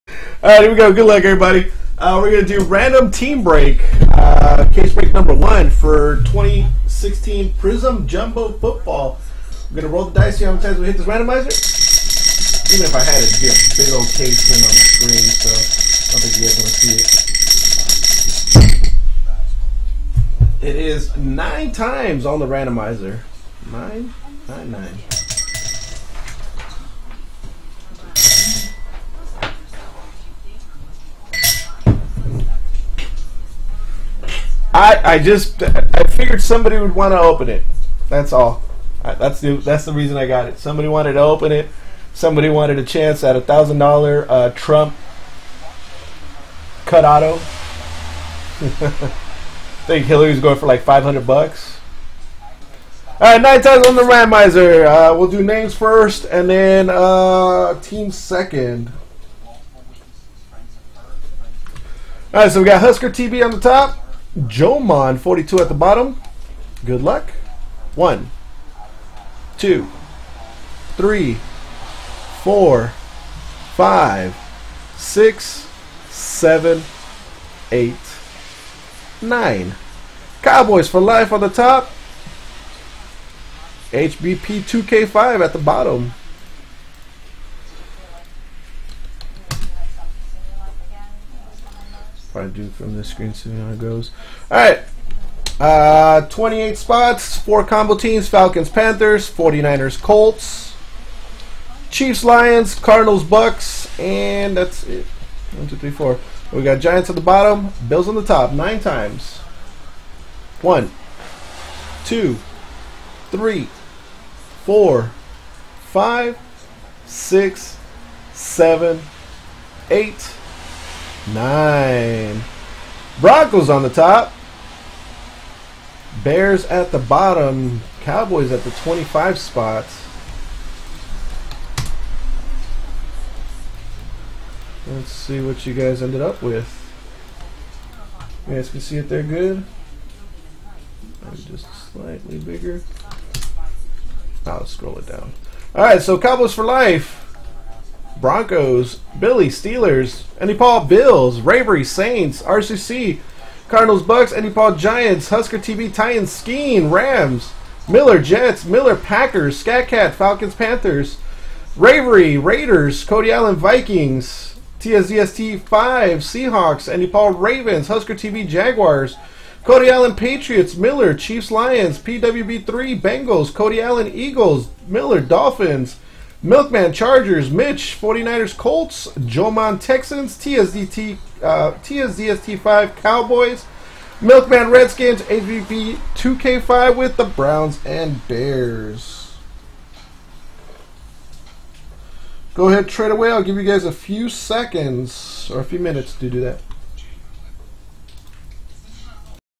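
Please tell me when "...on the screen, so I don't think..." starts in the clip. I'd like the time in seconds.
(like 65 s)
14 s.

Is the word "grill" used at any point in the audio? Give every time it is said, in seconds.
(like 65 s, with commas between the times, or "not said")
not said.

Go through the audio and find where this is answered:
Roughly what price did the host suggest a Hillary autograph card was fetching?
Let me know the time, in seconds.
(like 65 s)
50 s.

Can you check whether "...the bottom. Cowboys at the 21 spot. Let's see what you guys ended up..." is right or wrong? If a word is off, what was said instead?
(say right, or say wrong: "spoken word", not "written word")
wrong: "25", not "21".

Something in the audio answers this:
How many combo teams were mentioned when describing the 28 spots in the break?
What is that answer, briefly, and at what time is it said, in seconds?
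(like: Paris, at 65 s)
4, at 97 s.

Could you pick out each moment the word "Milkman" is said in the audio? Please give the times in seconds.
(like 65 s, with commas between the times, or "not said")
176 s, 184 s.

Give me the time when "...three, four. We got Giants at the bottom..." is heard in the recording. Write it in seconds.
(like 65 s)
105 s.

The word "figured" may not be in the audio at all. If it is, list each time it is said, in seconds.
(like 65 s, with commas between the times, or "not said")
36 s.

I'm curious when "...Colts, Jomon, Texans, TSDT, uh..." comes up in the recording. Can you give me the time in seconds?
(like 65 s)
178 s.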